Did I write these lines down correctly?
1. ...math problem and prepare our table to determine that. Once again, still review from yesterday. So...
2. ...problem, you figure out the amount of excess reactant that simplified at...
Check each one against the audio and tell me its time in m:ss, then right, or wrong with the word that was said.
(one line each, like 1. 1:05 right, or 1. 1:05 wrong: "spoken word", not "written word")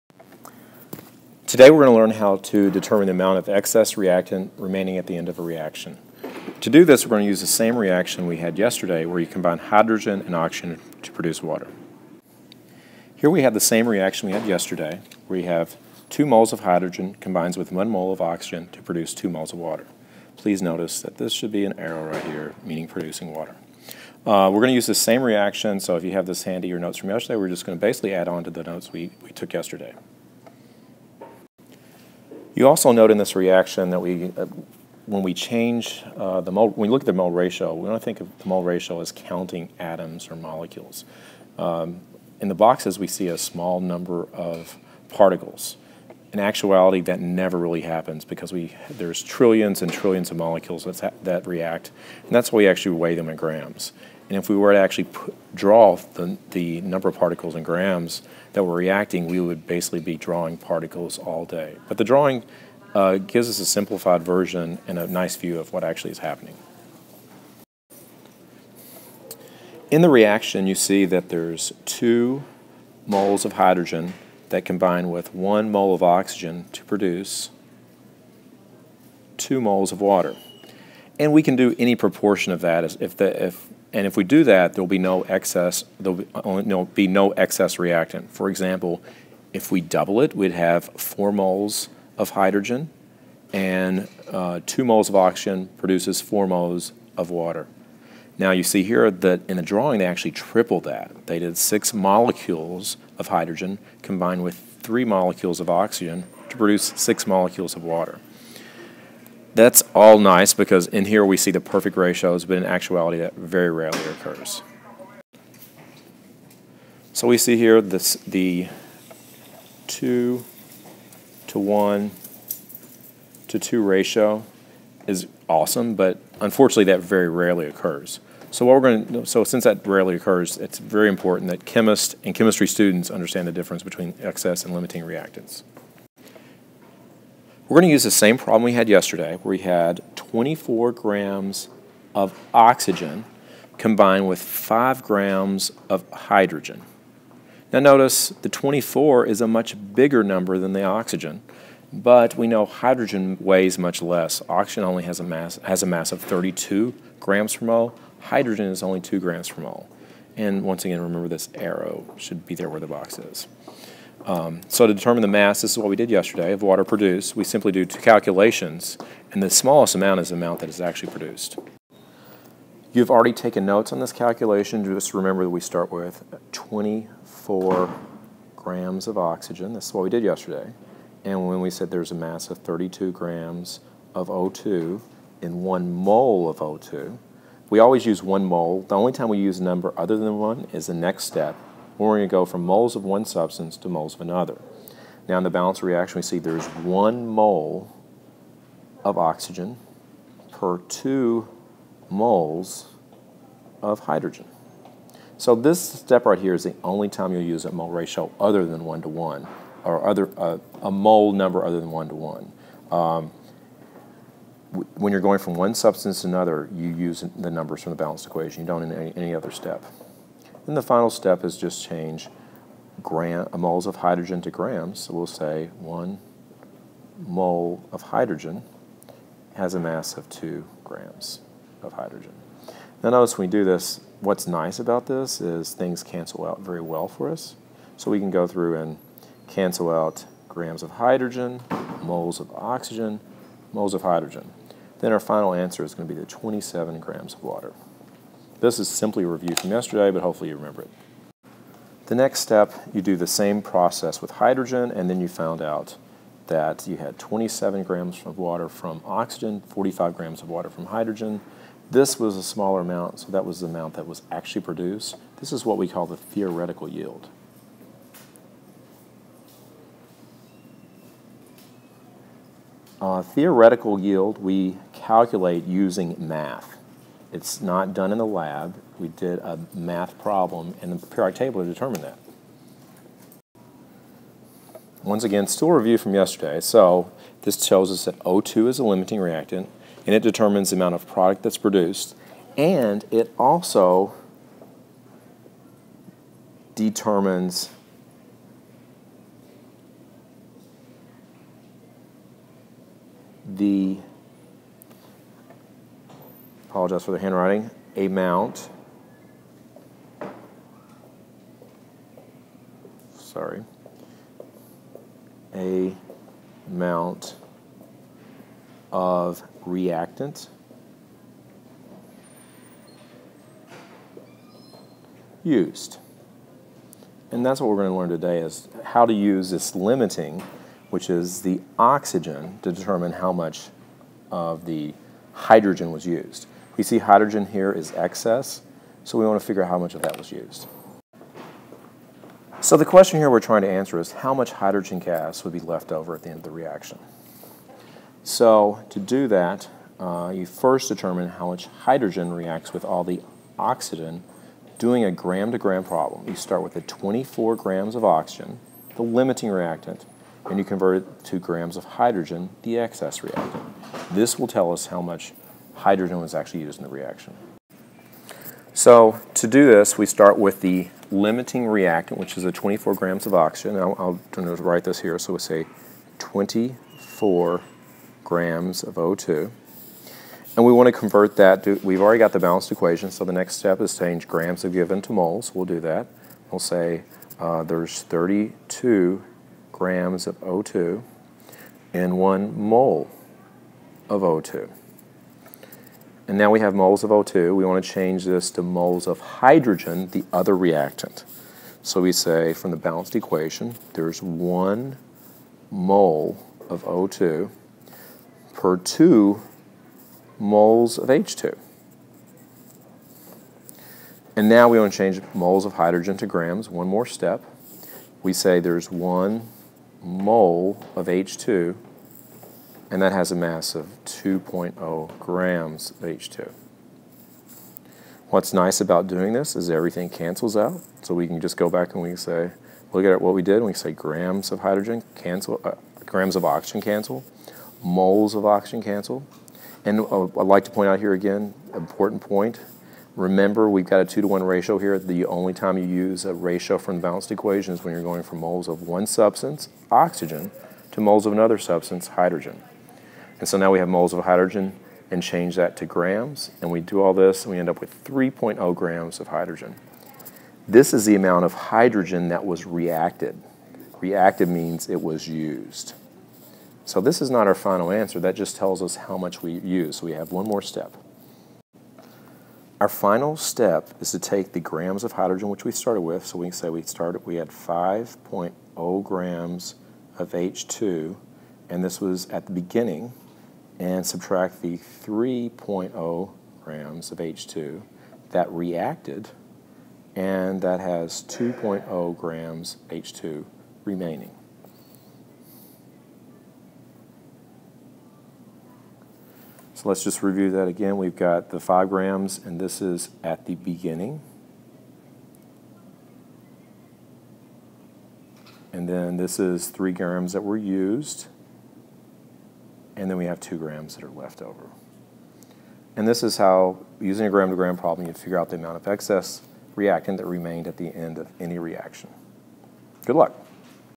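1. 4:39 right
2. 8:37 wrong: "remained", not "simplified".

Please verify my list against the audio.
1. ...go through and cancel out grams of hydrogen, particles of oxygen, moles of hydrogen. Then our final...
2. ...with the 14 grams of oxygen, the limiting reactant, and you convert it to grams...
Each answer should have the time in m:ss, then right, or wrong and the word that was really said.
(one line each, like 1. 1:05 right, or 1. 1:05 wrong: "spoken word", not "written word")
1. 3:58 wrong: "moles", not "particles"
2. 5:56 wrong: "24", not "14".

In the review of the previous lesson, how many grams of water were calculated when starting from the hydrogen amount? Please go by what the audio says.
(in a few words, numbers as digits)
45 grams.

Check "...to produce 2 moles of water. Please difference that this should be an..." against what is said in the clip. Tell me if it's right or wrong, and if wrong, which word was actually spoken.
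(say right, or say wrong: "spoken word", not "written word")
wrong: "notice", not "difference".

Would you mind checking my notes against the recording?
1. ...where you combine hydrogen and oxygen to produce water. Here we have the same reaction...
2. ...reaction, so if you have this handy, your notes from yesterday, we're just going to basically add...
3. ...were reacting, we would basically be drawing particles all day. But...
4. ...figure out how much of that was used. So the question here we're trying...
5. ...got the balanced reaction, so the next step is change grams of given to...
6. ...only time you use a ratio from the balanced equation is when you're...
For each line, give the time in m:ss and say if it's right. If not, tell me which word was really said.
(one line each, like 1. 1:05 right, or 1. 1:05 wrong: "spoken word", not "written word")
1. 0:09 right
2. 0:25 right
3. 0:58 right
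4. 5:39 right
5. 6:22 wrong: "equation", not "reaction"
6. 7:25 right.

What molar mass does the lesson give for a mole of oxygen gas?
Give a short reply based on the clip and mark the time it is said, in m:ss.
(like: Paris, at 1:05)
32 grams per mole, at 2:36.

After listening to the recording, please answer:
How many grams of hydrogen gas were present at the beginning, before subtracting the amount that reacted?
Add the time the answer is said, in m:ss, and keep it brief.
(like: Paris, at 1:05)
5.0 grams, at 7:57.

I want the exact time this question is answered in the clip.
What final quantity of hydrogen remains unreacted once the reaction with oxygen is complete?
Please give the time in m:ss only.
8:11.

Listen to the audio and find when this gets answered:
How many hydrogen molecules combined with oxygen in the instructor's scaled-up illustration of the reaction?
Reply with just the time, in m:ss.
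1:41.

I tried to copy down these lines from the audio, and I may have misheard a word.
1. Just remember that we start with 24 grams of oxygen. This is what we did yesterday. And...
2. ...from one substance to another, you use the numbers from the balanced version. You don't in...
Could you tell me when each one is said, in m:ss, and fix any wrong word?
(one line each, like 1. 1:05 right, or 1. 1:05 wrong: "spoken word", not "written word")
1. 2:54 right
2. 3:35 wrong: "equation", not "version".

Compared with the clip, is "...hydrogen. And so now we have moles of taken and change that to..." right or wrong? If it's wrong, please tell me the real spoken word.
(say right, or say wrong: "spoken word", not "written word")
wrong: "hydrogen", not "taken".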